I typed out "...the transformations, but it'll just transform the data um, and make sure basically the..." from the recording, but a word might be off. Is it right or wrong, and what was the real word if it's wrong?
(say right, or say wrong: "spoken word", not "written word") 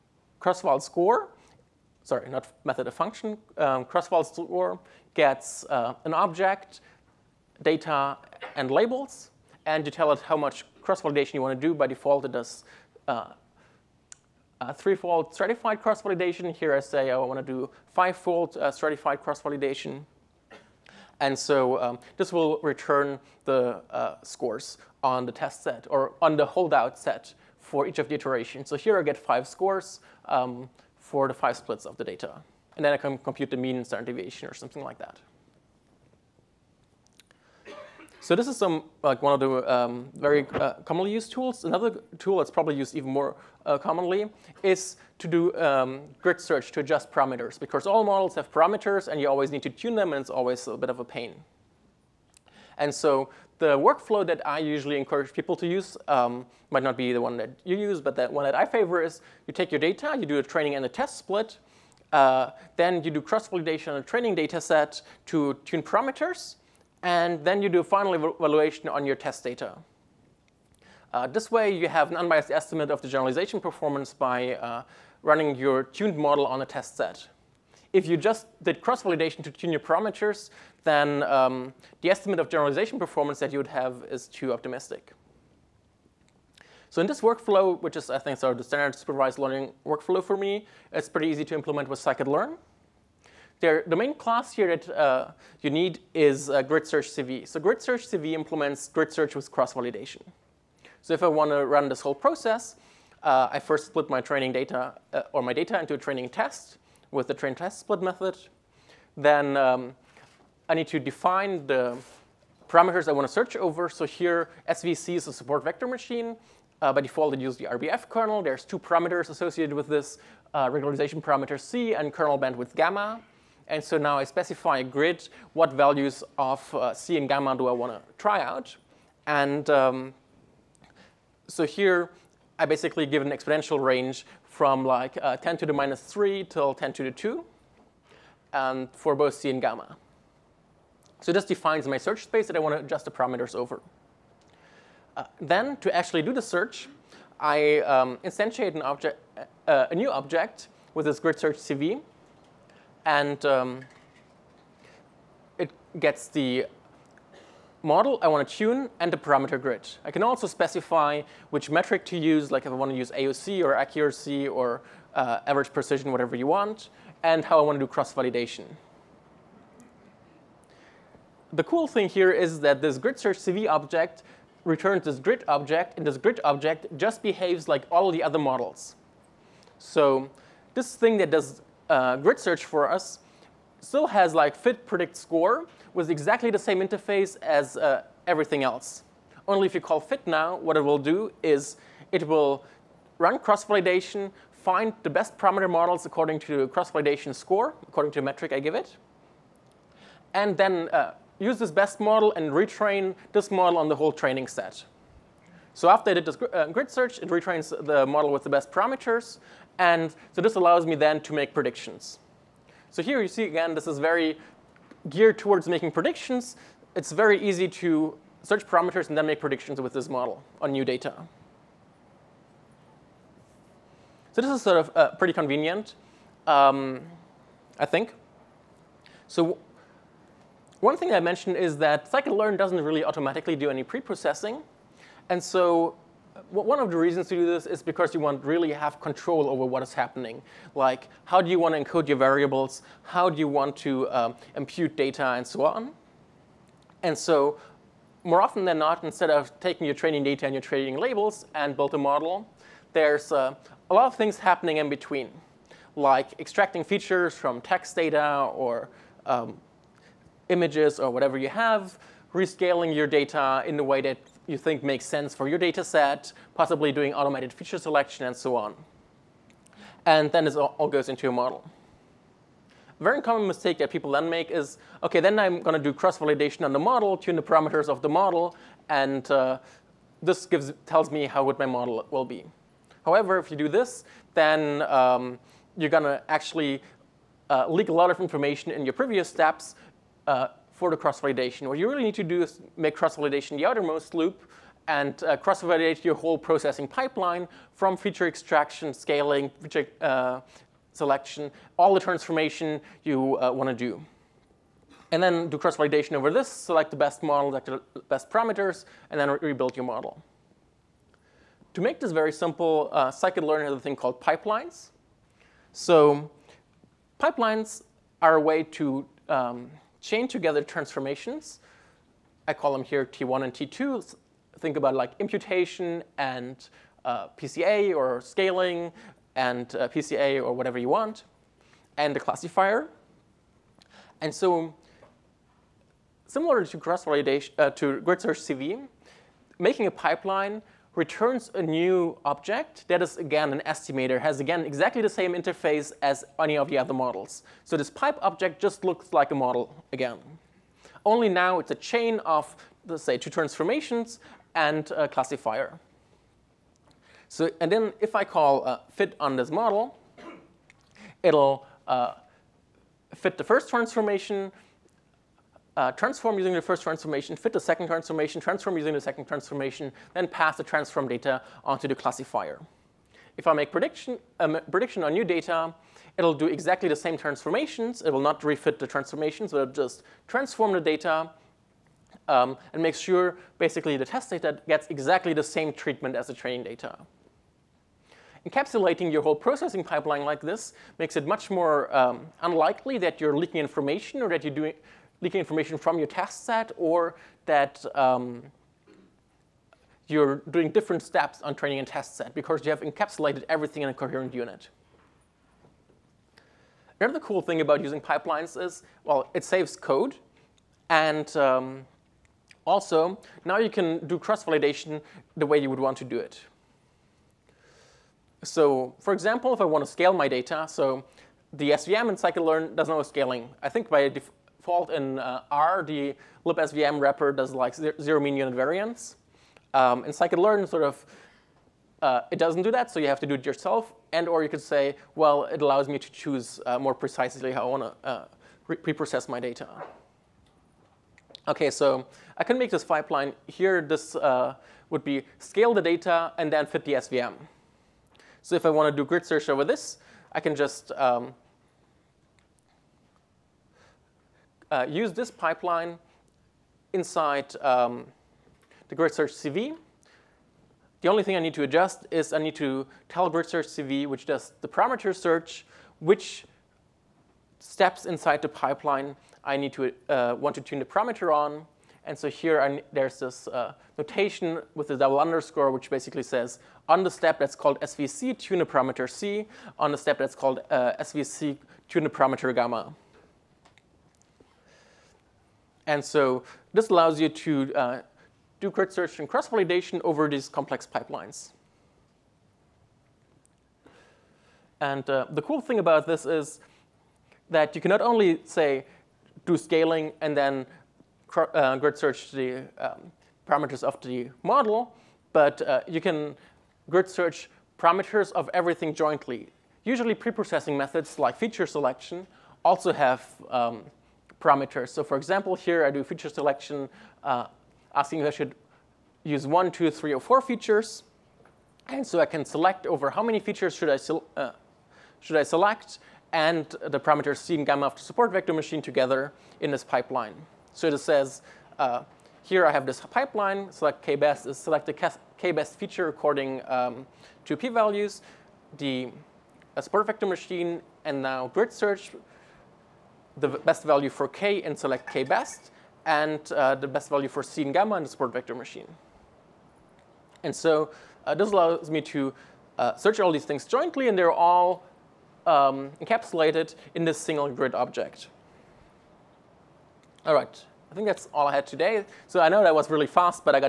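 right.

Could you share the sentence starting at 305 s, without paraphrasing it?
And then do cross-validation over this, select the best model, select the best parameters, and then re rebuild your model.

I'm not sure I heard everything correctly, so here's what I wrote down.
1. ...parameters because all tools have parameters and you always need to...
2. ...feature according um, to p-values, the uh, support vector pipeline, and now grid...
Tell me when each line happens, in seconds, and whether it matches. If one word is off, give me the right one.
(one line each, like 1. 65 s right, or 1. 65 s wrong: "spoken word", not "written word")
1. 47 s wrong: "models", not "tools"
2. 535 s wrong: "machine", not "pipeline".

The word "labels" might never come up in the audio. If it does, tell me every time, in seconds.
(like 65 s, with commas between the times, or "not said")
8 s, 250 s.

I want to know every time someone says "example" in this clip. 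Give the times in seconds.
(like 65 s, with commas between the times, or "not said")
419 s, 515 s.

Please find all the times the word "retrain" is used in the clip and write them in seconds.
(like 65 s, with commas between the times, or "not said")
202 s, 207 s.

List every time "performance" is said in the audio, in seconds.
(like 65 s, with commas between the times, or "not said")
73 s, 82 s.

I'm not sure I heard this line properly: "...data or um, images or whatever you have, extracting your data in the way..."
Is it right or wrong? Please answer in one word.
wrong.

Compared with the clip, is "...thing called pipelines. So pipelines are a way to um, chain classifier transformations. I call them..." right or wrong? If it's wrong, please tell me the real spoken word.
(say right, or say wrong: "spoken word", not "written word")
wrong: "together", not "classifier".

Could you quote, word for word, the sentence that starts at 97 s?
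So grid search CV implements grid search with cross-validation.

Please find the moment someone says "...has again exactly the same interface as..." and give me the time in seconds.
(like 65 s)
344 s.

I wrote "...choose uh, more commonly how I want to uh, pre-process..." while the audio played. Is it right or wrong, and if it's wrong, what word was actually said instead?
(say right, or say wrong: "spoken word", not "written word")
wrong: "precisely", not "commonly".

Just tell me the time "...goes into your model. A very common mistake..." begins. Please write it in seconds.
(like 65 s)
270 s.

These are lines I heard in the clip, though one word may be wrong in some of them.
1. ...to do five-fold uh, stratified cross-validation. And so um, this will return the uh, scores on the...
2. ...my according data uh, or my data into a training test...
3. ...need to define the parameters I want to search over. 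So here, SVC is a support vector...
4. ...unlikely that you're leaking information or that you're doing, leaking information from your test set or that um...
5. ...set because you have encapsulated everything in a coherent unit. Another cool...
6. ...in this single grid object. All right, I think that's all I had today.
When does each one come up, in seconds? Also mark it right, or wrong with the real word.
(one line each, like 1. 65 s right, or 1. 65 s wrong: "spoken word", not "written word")
1. 17 s right
2. 104 s wrong: "training", not "according"
3. 110 s right
4. 392 s right
5. 402 s right
6. 556 s right.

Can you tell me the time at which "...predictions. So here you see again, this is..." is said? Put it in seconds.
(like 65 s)
211 s.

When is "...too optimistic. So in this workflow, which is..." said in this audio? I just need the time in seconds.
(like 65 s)
84 s.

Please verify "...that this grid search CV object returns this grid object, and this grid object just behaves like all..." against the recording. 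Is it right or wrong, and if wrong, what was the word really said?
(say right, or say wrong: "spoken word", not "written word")
right.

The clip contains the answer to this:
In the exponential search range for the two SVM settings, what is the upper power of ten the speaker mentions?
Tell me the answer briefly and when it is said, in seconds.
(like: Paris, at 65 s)
10 to the 2, at 136 s.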